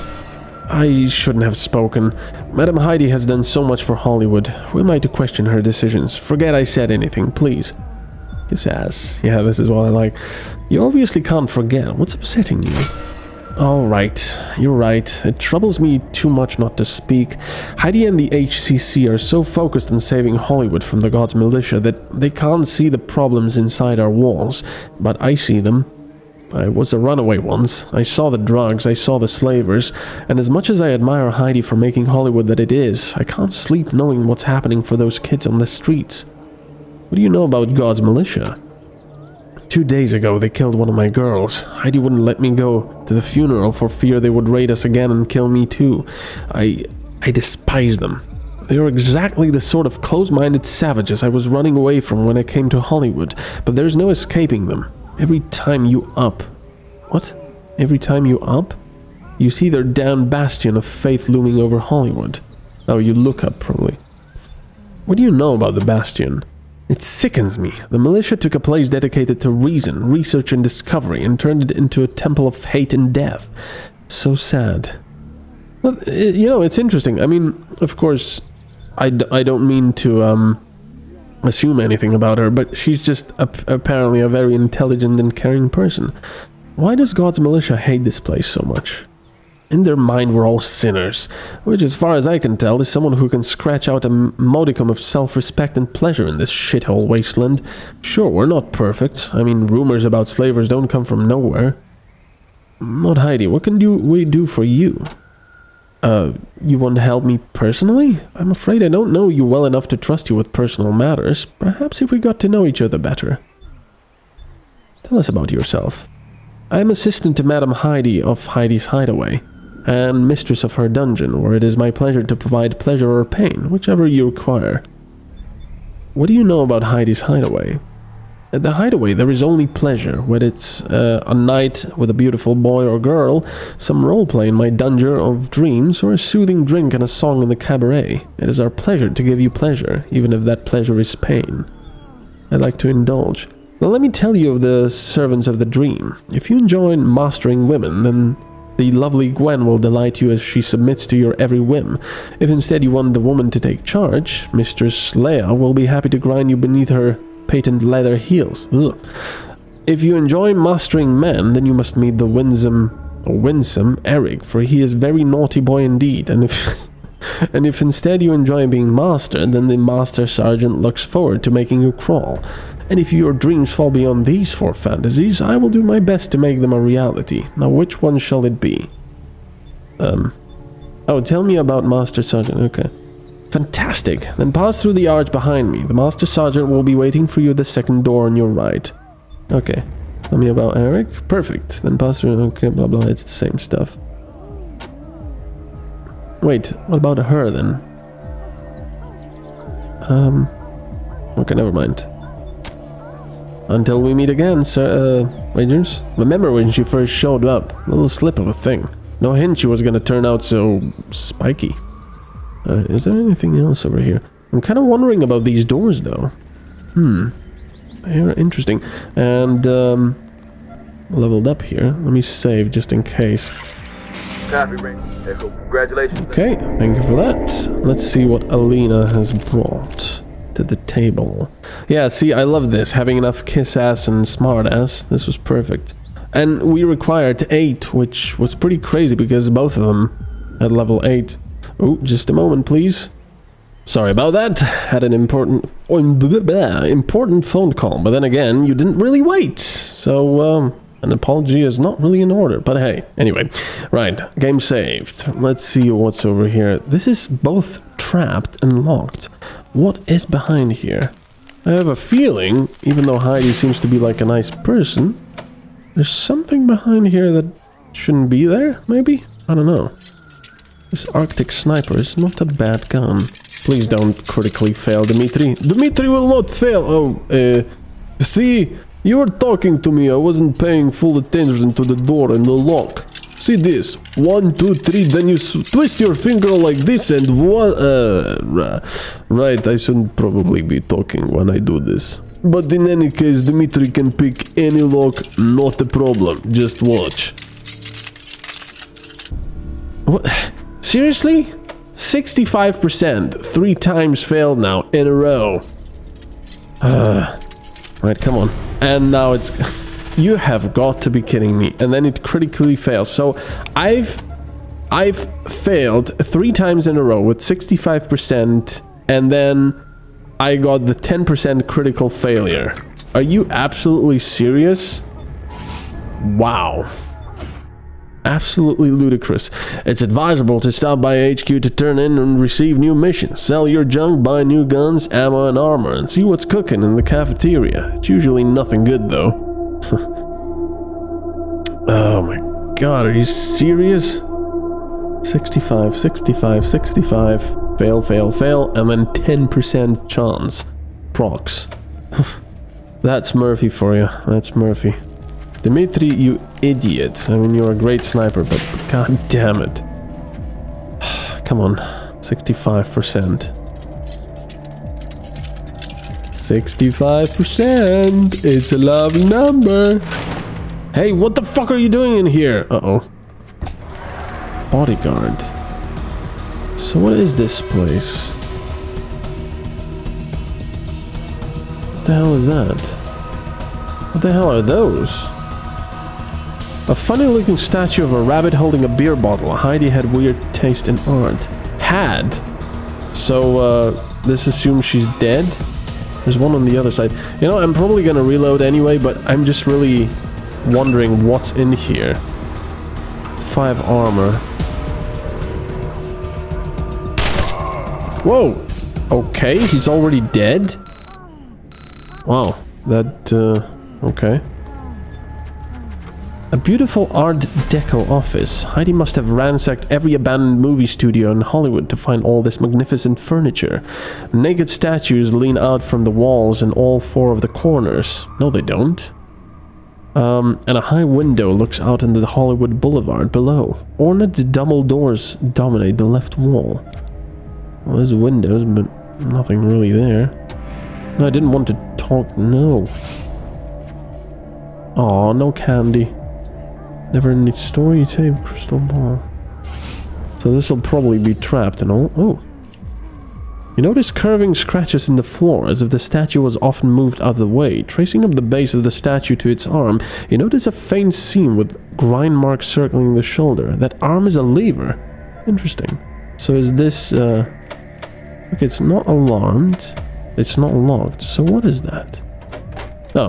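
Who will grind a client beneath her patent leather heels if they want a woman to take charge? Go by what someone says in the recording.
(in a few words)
Mistress Leia.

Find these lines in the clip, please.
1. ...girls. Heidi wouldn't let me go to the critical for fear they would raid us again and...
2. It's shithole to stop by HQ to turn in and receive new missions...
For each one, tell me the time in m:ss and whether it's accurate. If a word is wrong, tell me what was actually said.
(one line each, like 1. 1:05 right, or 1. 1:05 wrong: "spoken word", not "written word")
1. 0:41 wrong: "funeral", not "critical"
2. 5:29 wrong: "advisable", not "shithole".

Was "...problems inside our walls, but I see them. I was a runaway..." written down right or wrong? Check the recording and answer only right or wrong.
right.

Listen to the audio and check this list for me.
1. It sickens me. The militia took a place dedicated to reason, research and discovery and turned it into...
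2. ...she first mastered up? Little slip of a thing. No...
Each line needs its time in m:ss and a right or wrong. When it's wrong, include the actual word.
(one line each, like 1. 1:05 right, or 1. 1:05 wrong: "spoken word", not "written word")
1. 1:06 right
2. 3:26 wrong: "showed", not "mastered".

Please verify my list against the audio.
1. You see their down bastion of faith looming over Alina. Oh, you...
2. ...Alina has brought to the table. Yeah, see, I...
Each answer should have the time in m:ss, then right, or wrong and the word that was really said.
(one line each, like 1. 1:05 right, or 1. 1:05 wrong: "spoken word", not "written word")
1. 0:59 wrong: "Hollywood", not "Alina"
2. 3:48 right.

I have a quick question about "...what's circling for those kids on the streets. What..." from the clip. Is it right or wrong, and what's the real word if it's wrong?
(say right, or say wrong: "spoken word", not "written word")
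wrong: "happening", not "circling".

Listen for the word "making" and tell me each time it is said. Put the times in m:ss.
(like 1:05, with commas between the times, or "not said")
0:31, 2:51.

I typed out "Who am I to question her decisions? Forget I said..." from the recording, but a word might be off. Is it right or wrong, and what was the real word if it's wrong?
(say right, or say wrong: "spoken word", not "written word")
right.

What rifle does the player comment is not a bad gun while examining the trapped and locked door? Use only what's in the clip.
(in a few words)
Arctic Sniper.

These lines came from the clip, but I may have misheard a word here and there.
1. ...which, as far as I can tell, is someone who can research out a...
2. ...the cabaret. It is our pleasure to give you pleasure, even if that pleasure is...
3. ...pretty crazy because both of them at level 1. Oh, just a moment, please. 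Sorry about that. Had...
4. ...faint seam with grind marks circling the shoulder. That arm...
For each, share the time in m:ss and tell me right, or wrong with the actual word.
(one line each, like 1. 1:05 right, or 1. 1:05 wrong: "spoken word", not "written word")
1. 1:31 wrong: "scratch", not "research"
2. 2:17 right
3. 3:58 wrong: "8", not "1"
4. 7:40 right.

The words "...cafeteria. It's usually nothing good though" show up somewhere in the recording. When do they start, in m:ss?
5:37.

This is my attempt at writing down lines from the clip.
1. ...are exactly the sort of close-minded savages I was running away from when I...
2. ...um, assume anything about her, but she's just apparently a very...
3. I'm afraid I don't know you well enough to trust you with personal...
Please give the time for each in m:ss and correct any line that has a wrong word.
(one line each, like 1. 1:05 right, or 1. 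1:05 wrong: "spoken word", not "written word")
1. 0:48 right
2. 1:20 right
3. 1:48 right.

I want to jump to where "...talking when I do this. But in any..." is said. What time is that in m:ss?
4:50.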